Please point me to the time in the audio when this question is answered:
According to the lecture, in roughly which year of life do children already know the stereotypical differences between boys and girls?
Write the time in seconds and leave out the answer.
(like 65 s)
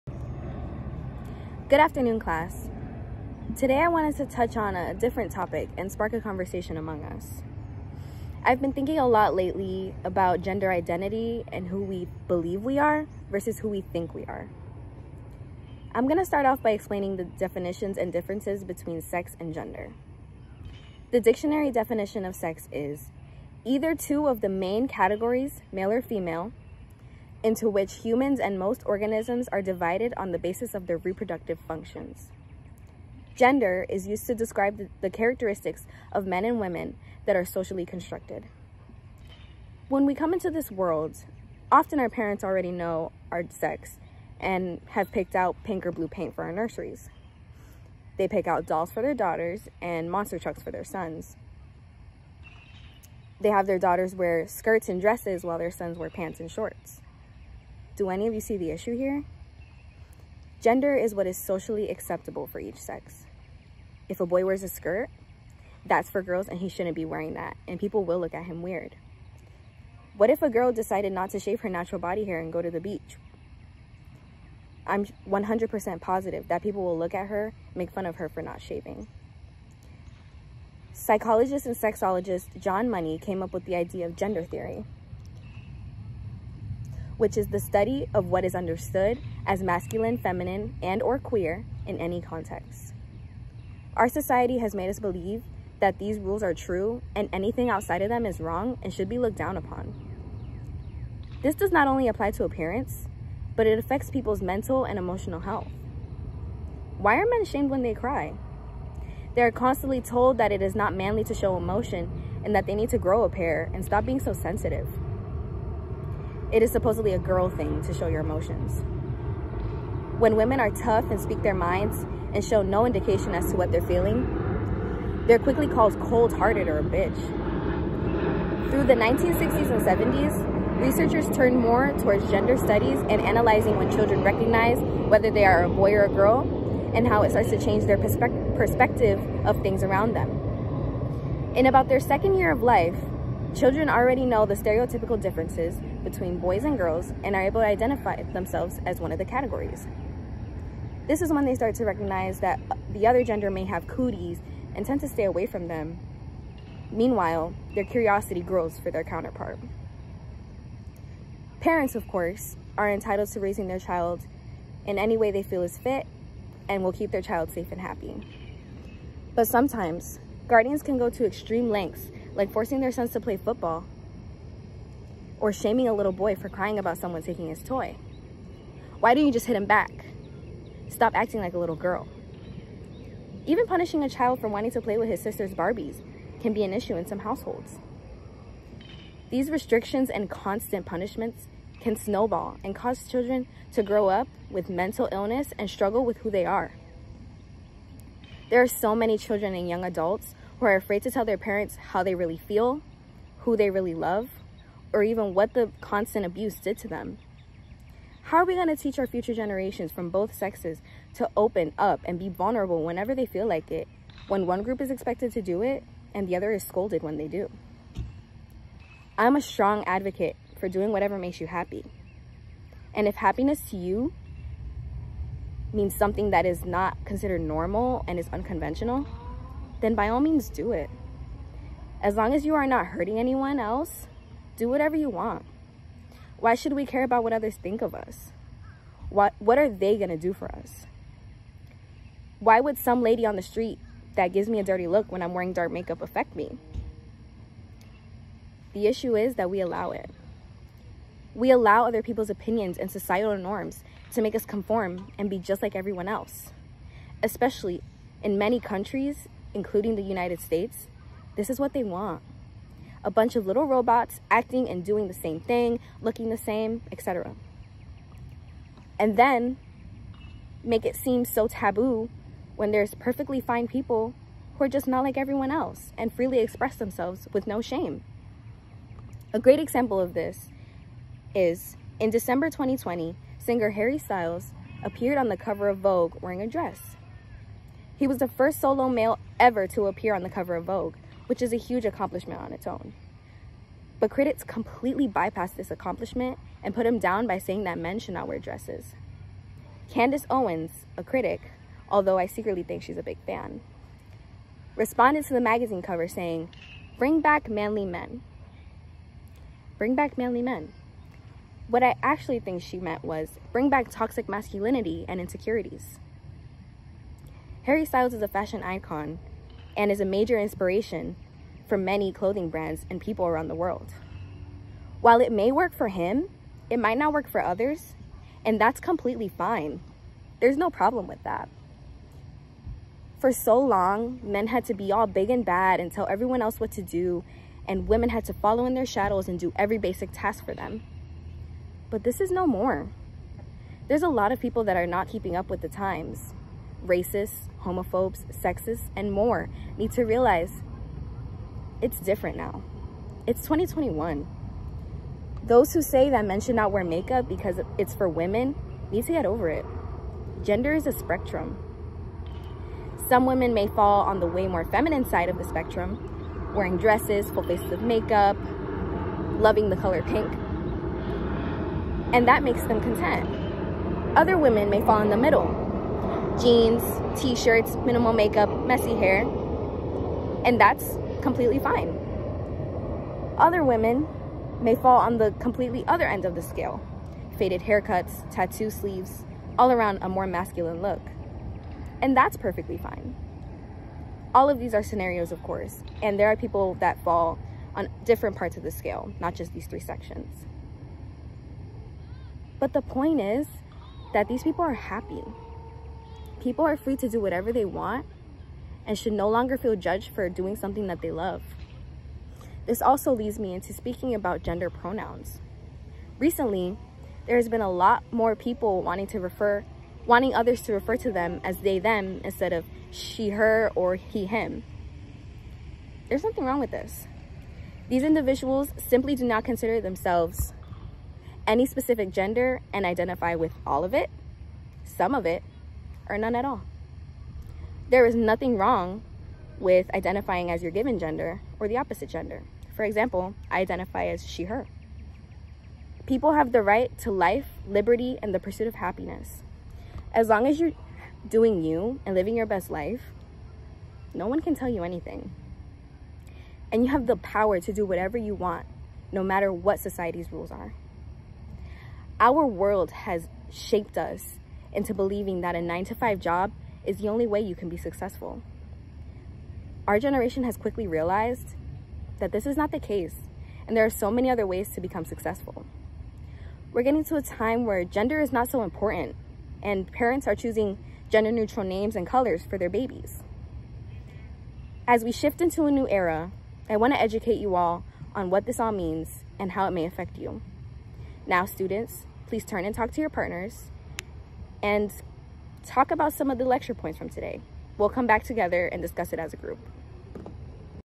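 142 s.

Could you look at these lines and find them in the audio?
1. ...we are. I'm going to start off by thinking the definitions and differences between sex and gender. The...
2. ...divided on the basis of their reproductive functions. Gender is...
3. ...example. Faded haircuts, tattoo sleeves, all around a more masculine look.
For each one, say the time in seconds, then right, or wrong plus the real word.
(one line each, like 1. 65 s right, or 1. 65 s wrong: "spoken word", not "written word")
1. 14 s wrong: "explaining", not "thinking"
2. 29 s right
3. 386 s wrong: "scale", not "example".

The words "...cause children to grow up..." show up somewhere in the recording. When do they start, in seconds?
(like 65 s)
192 s.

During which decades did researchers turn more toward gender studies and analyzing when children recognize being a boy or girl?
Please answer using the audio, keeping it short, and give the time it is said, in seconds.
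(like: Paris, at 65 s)
1960s and 70s, at 128 s.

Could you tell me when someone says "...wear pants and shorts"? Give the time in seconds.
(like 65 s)
55 s.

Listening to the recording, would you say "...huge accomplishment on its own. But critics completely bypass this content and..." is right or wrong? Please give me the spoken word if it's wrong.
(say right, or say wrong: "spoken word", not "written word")
wrong: "accomplishment", not "content".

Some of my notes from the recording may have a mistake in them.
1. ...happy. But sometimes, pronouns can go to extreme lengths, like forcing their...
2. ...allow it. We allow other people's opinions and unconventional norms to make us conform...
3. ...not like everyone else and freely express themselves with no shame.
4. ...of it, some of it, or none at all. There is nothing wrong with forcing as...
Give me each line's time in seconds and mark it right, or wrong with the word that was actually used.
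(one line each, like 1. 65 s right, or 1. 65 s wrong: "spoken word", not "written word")
1. 167 s wrong: "guardians", not "pronouns"
2. 249 s wrong: "societal", not "unconventional"
3. 274 s right
4. 433 s wrong: "identifying", not "forcing".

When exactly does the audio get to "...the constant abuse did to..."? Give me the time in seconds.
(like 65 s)
205 s.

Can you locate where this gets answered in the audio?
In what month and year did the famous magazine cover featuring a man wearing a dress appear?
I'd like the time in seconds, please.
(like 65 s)
282 s.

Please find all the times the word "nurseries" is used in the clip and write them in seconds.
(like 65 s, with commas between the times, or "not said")
46 s.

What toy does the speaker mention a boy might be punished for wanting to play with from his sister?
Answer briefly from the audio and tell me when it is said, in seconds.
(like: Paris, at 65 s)
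Barbies, at 185 s.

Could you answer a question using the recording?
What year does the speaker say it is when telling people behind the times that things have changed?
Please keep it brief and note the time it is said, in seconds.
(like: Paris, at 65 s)
2021, at 353 s.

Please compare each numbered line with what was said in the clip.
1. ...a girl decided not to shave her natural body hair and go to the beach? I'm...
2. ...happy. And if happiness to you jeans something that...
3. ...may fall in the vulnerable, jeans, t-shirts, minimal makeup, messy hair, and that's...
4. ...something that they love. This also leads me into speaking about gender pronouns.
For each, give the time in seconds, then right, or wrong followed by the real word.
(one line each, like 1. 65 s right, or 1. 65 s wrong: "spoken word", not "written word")
1. 70 s right
2. 221 s wrong: "means", not "jeans"
3. 374 s wrong: "middle", not "vulnerable"
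4. 410 s right.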